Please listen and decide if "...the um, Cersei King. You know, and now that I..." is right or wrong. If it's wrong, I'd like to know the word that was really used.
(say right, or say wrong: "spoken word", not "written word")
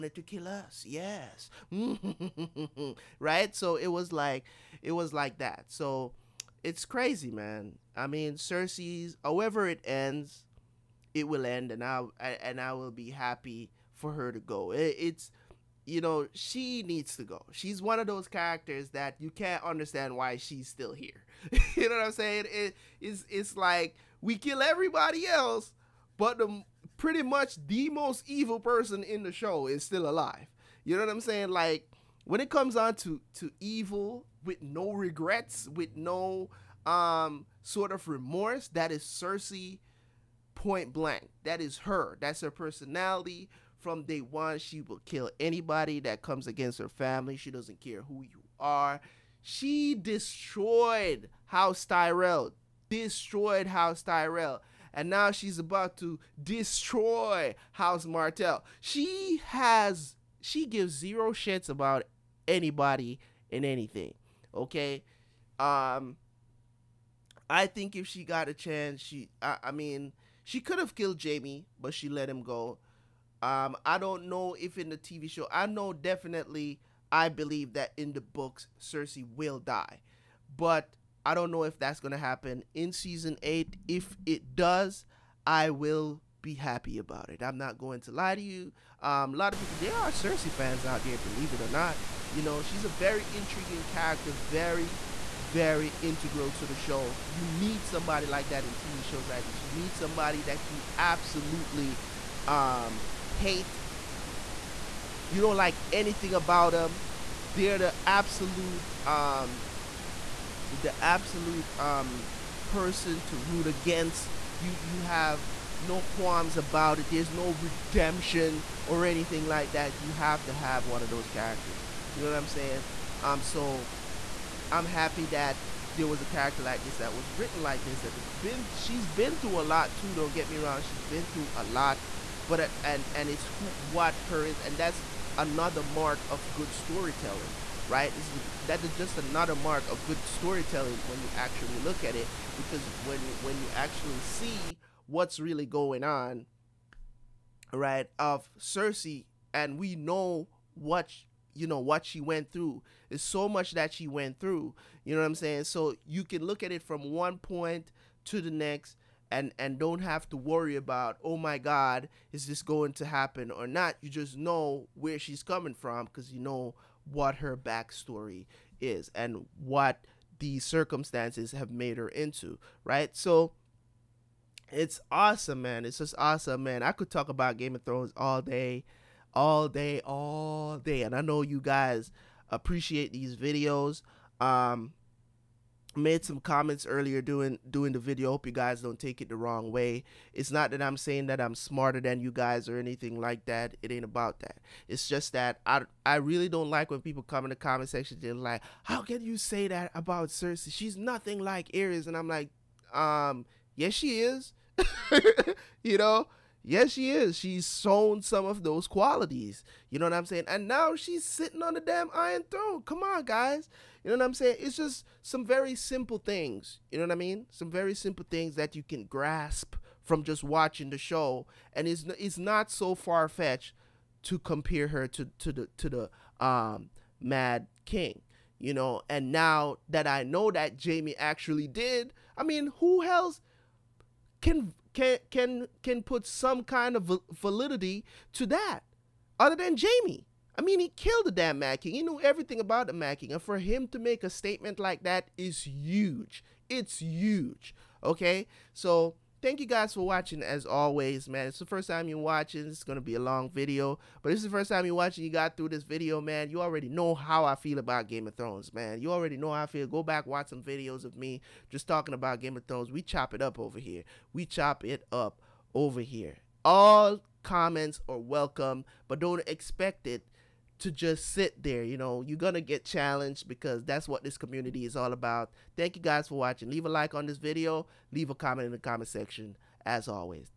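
wrong: "Mad", not "Cersei".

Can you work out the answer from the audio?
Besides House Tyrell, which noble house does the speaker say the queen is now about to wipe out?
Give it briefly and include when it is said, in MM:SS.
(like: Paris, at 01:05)
House Martell, at 00:57.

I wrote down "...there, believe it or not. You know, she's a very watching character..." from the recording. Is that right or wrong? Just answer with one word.
wrong.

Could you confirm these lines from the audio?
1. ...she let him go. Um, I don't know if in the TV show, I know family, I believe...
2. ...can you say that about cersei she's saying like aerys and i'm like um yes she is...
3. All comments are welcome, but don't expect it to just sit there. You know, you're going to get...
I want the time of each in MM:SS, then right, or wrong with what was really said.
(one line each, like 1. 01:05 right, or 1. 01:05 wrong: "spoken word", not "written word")
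1. 01:11 wrong: "definitely", not "family"
2. 03:19 wrong: "nothing", not "saying"
3. 04:26 right.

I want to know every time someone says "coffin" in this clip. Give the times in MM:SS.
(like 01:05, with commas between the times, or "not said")
not said.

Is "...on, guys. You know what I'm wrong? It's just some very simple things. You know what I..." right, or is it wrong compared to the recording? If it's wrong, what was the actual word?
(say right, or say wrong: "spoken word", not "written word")
wrong: "saying", not "wrong".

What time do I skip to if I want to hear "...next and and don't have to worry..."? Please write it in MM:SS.
02:38.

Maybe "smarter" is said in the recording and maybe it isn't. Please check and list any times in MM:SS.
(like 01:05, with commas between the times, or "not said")
03:11.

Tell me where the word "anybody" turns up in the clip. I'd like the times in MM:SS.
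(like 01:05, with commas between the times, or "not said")
00:45, 01:02.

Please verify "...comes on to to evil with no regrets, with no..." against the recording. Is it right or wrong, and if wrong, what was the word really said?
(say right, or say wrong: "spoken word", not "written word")
right.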